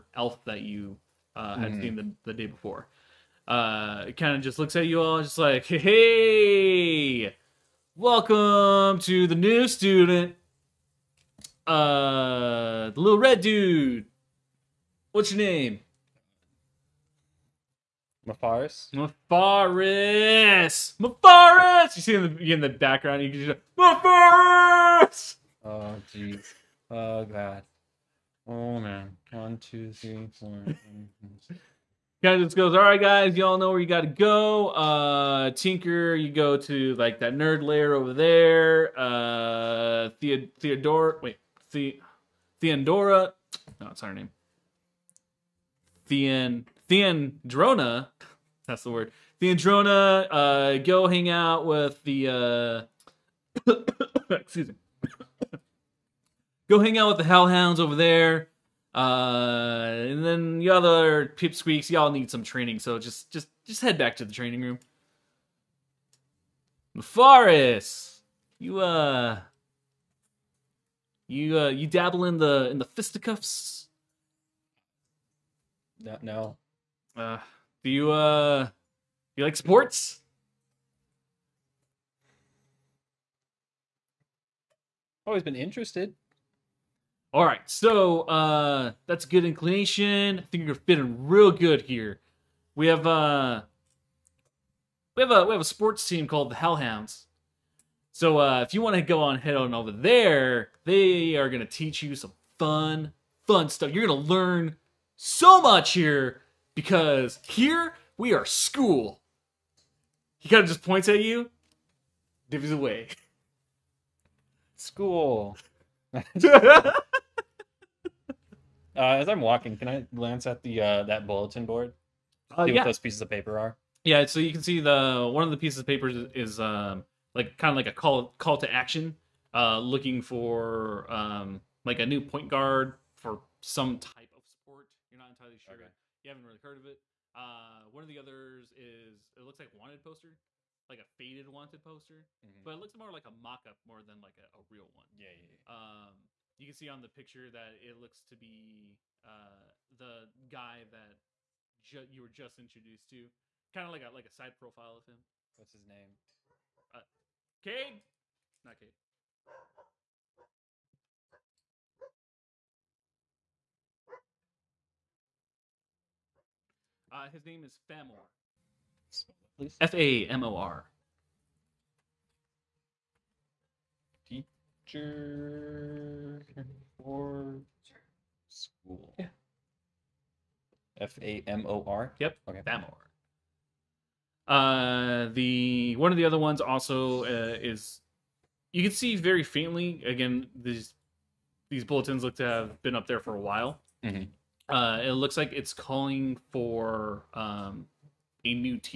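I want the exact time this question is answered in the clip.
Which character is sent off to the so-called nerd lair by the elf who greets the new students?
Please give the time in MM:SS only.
00:35.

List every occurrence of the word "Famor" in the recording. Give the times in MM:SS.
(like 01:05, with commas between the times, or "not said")
02:47, 03:02.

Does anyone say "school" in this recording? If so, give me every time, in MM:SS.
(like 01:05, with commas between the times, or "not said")
01:48, 01:54, 02:58.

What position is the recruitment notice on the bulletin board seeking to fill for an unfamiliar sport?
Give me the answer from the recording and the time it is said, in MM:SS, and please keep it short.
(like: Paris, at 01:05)
Point guard, at 02:12.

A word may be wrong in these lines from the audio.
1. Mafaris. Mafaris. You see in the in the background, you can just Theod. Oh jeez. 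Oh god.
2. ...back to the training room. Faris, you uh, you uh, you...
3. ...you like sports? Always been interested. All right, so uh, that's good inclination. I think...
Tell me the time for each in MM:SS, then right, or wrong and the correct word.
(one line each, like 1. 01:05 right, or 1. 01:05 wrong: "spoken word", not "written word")
1. 00:18 wrong: "Mafaris", not "Theod"
2. 01:03 right
3. 01:19 right.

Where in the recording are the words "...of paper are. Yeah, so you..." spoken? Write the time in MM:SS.
02:03.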